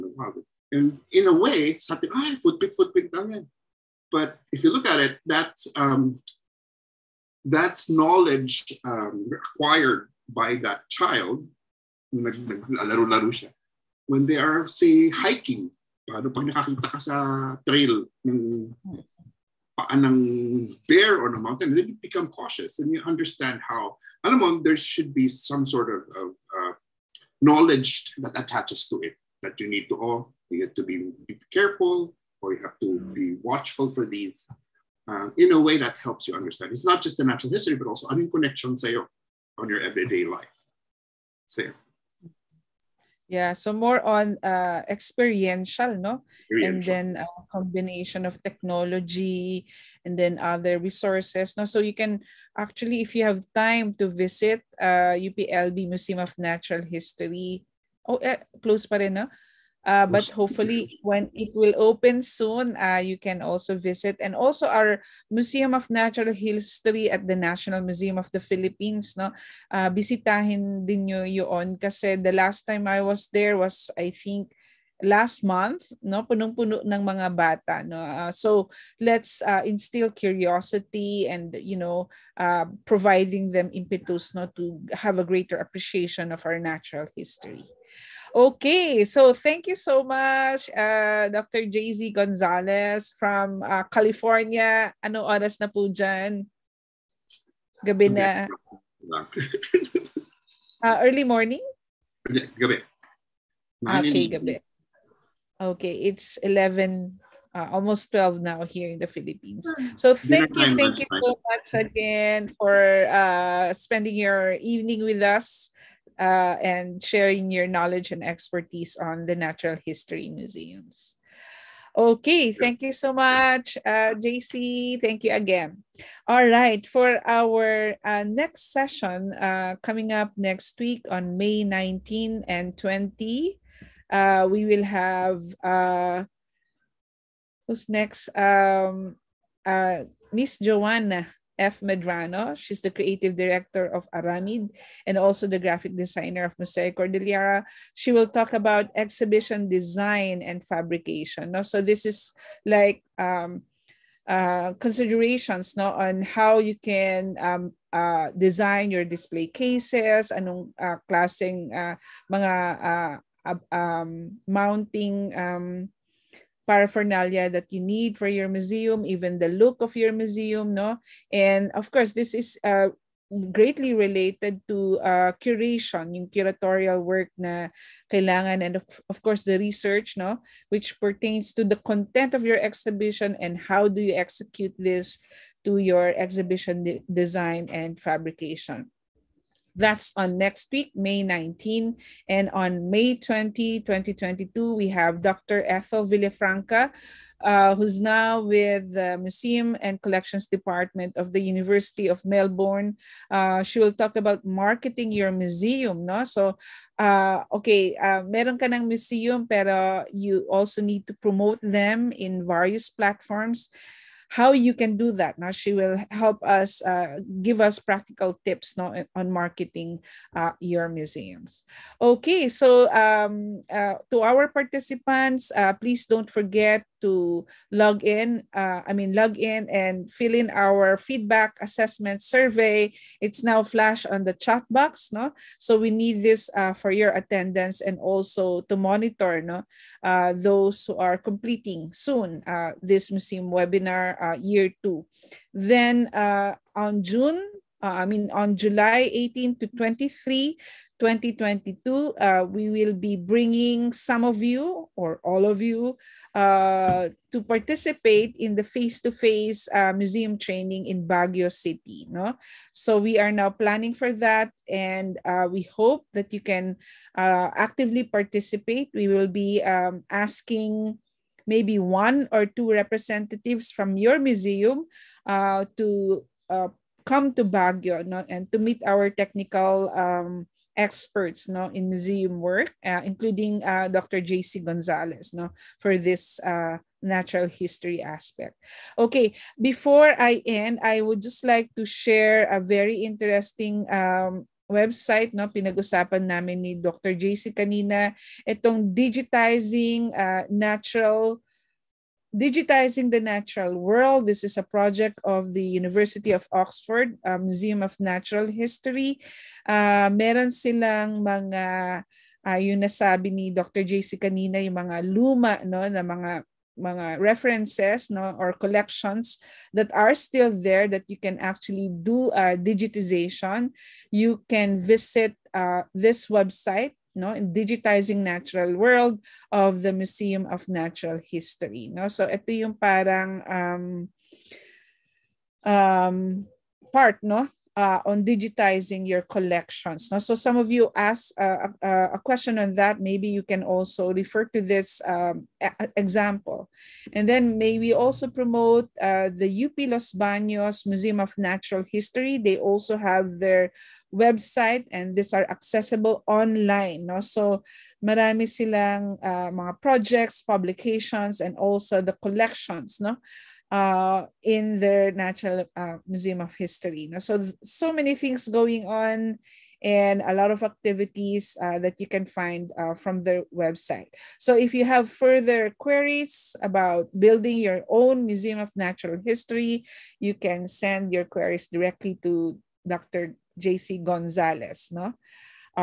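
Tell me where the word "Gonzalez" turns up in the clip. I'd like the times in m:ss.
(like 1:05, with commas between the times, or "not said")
1:32, 4:44, 6:24.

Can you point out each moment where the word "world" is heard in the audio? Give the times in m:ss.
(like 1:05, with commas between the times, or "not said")
5:03, 5:28.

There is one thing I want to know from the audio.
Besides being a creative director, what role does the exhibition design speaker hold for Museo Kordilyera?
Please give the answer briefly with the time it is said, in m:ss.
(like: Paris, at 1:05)
graphic designer, at 2:25.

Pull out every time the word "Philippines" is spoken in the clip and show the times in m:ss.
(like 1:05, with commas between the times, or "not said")
1:08, 1:49.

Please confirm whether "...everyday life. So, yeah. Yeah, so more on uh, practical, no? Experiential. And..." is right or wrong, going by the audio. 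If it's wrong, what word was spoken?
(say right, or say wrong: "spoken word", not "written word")
wrong: "experiential", not "practical".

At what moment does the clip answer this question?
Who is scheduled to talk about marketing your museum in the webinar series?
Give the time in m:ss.
3:15.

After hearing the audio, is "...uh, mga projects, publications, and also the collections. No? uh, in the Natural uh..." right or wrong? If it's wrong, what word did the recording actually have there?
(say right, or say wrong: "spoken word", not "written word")
right.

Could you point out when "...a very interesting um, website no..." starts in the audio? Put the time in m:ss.
4:52.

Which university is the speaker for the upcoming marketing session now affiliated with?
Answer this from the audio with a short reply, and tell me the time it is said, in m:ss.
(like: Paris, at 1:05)
University of Melbourne, at 3:21.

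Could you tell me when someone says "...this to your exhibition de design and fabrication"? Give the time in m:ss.
3:04.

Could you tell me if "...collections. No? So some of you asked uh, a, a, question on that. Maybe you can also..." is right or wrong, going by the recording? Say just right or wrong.
right.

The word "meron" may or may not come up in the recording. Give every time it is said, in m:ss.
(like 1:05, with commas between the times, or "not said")
3:28, 5:10.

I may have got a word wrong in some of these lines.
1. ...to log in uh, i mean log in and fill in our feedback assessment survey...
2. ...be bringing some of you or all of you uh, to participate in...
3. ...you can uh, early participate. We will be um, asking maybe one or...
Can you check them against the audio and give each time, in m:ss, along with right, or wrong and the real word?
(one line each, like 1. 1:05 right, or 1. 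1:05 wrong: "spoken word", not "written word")
1. 3:47 right
2. 4:12 right
3. 4:26 wrong: "actively", not "early".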